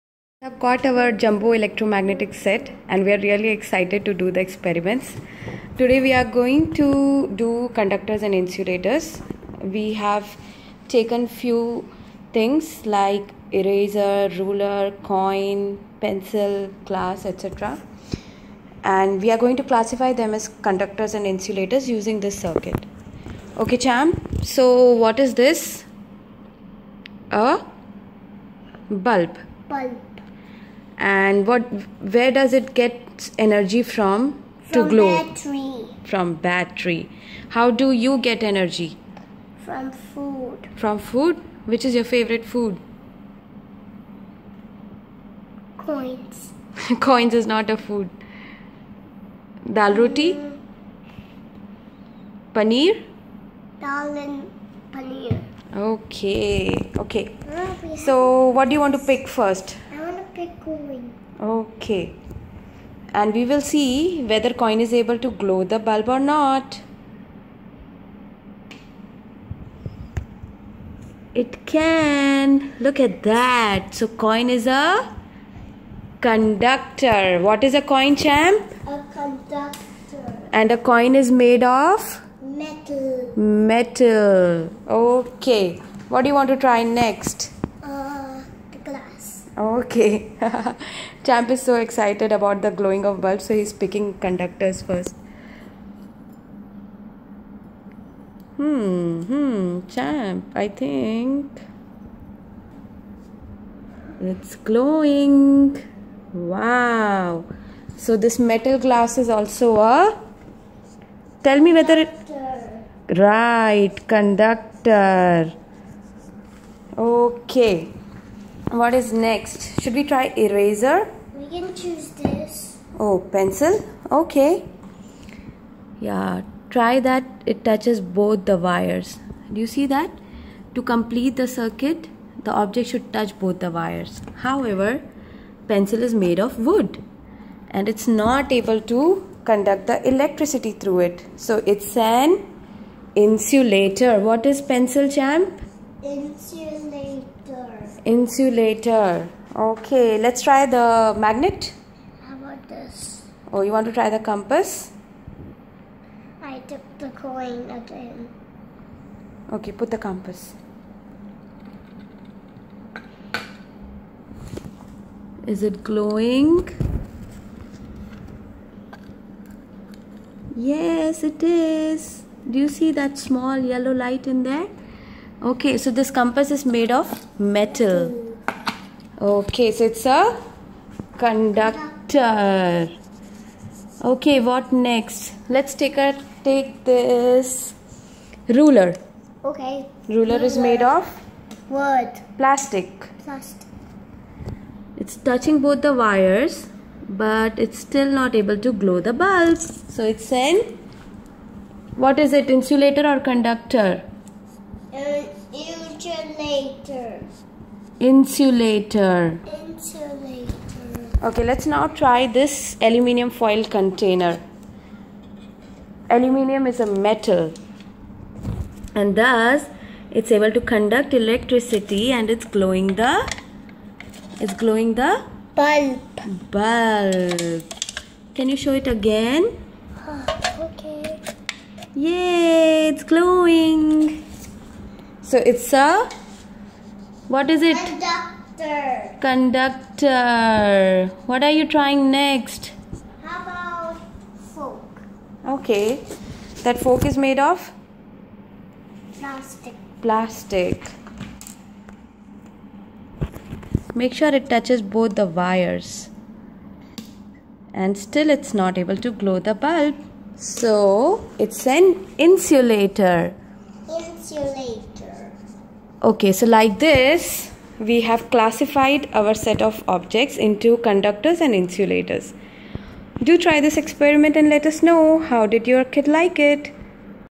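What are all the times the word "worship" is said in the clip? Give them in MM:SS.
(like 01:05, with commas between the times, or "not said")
not said.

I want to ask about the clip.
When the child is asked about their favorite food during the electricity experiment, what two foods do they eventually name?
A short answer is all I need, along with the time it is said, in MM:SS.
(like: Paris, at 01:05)
dal and paneer, at 00:52.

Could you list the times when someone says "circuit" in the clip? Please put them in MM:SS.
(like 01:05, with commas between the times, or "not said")
00:22, 02:11.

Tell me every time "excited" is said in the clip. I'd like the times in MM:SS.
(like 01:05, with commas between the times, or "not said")
00:03, 01:31.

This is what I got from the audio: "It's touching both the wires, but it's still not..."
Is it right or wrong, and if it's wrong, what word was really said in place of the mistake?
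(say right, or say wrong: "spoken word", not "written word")
right.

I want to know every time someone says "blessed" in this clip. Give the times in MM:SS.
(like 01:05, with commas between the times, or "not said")
not said.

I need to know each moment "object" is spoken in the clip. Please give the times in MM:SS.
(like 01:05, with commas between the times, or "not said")
02:12, 04:29.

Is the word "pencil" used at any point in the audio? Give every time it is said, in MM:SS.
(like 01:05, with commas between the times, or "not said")
00:15, 02:03, 02:15, 02:24.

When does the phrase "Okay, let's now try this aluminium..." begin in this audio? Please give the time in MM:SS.
03:31.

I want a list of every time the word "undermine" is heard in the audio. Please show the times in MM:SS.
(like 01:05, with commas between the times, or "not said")
not said.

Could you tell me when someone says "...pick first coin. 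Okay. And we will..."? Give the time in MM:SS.
00:59.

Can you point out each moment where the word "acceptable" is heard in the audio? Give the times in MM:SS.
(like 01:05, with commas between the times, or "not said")
not said.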